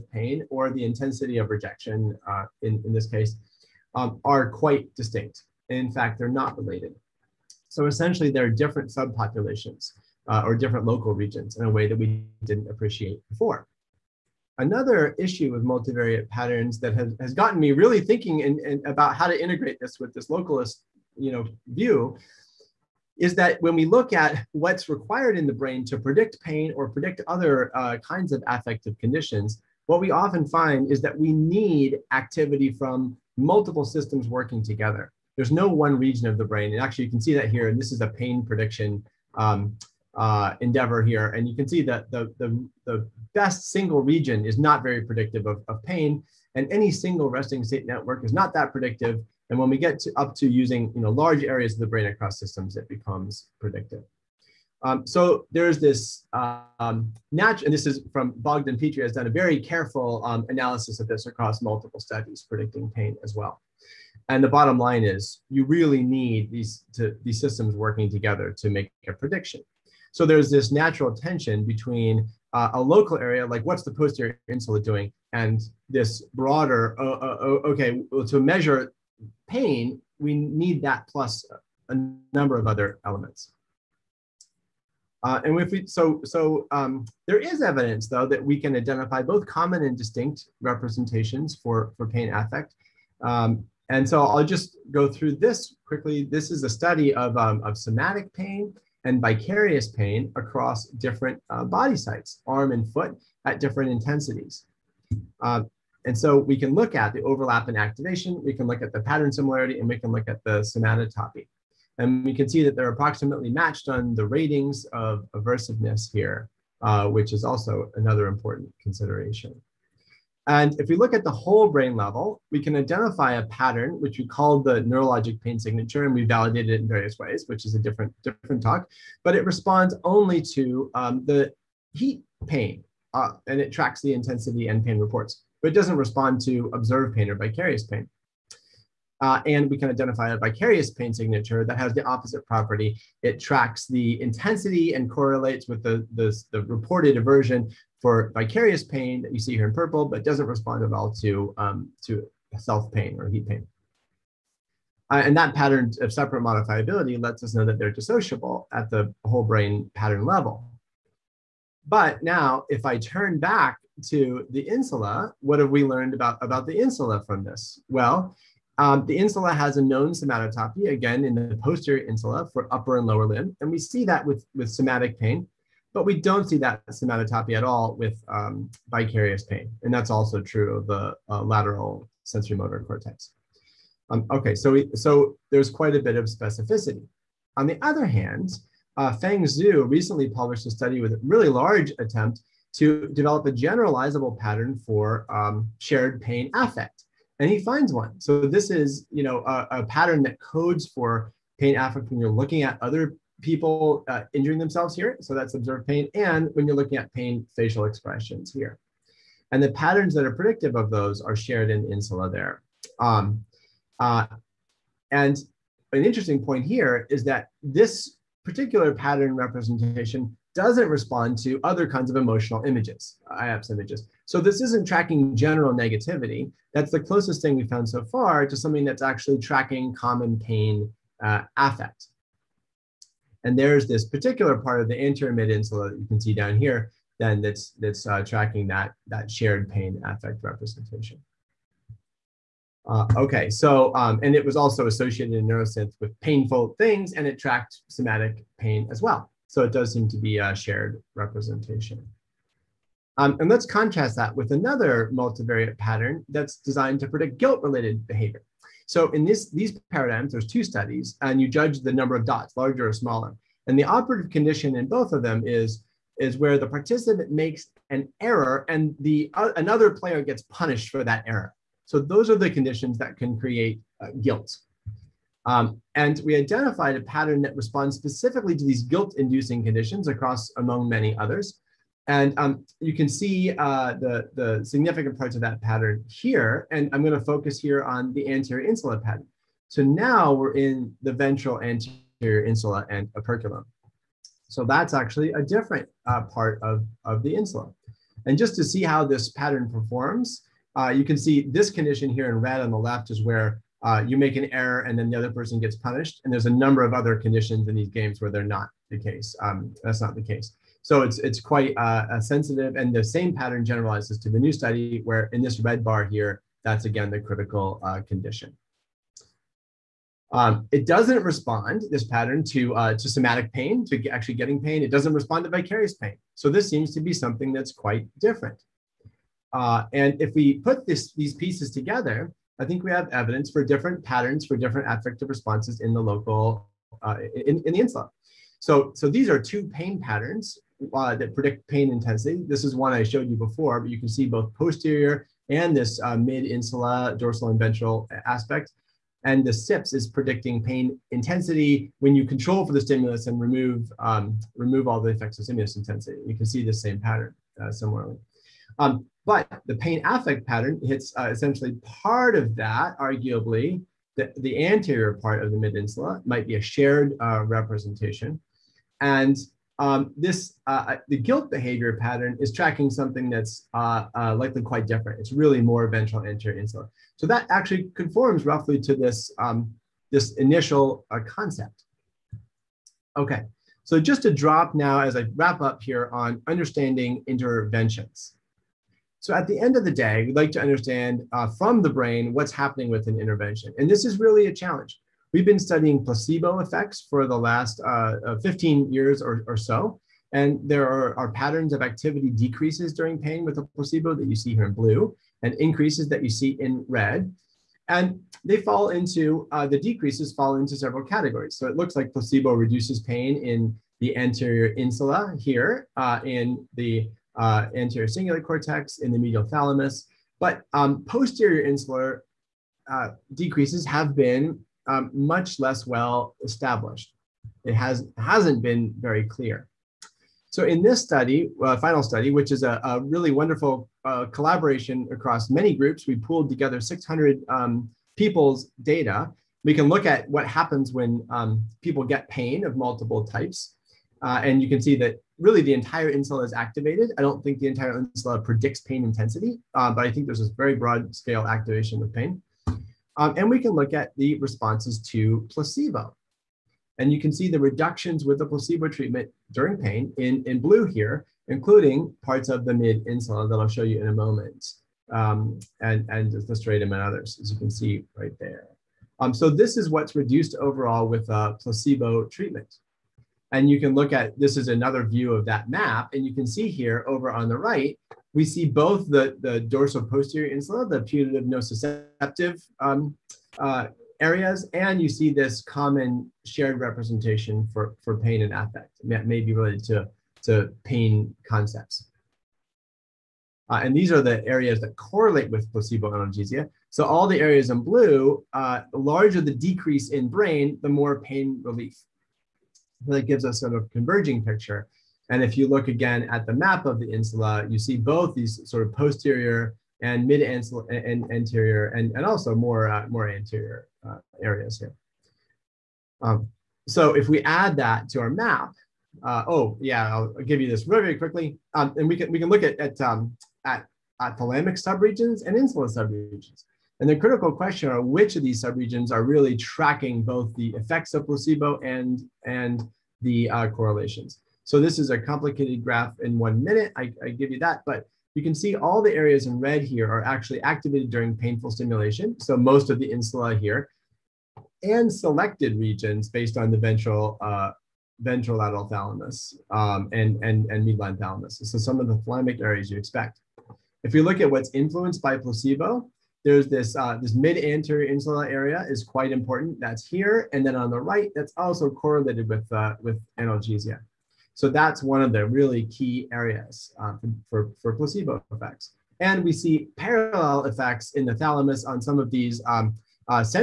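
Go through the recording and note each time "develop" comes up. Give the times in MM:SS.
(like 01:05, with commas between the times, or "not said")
03:13.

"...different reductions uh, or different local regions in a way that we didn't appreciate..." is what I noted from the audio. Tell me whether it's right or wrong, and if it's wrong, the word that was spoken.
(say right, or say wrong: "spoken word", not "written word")
wrong: "subpopulations", not "reductions".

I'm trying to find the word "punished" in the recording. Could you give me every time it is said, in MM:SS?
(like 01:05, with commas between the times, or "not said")
04:30, 05:05.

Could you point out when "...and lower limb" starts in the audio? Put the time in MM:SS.
02:52.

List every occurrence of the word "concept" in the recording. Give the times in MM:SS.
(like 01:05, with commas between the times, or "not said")
06:21, 08:11.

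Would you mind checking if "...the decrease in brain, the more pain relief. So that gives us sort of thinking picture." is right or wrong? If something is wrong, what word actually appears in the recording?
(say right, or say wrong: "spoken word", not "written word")
wrong: "converging", not "thinking".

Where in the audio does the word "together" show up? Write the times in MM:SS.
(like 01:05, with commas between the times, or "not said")
00:34, 01:08, 05:31, 07:16.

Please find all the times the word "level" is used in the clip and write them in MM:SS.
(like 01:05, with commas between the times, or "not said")
02:01, 02:40.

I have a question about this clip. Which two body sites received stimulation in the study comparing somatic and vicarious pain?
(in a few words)
arm and foot.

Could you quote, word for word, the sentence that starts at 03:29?
And the patterns that are predictive of those are shared in insula there.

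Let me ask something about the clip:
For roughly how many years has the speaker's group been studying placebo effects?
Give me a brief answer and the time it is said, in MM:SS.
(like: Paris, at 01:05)
15 years, at 06:38.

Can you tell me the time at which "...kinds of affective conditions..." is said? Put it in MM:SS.
00:27.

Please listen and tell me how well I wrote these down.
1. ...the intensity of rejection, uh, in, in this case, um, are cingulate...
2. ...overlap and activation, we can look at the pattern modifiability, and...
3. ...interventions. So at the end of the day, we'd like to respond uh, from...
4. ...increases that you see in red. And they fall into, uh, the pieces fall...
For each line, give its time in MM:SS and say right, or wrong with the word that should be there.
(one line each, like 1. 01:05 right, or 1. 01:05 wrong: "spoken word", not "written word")
1. 00:00 wrong: "quite", not "cingulate"
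2. 01:47 wrong: "similarity", not "modifiability"
3. 06:27 wrong: "understand", not "respond"
4. 06:45 wrong: "decreases", not "pieces".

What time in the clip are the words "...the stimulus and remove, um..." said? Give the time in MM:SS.
05:52.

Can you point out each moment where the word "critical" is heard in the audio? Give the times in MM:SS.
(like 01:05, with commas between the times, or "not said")
05:17, 08:47.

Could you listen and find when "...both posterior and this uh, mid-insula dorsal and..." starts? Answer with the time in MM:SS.
05:44.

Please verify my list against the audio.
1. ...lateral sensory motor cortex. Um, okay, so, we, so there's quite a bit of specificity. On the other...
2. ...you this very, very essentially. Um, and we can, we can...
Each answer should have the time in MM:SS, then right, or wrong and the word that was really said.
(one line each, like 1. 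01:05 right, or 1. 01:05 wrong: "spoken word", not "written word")
1. 03:01 right
2. 08:40 wrong: "quickly", not "essentially".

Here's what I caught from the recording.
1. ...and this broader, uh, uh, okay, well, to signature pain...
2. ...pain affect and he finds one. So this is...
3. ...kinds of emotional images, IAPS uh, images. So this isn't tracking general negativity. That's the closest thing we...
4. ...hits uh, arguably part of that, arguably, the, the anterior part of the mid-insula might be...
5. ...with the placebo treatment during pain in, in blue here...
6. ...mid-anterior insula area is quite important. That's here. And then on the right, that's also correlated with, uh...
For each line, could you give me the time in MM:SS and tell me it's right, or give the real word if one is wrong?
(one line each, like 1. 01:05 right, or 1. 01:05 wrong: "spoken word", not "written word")
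1. 01:15 wrong: "measure", not "signature"
2. 03:16 right
3. 03:41 right
4. 06:00 wrong: "essentially", not "arguably"
5. 07:38 right
6. 09:17 right.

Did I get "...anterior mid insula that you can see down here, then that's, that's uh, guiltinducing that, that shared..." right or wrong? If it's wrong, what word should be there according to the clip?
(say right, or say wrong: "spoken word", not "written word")
wrong: "tracking", not "guiltinducing".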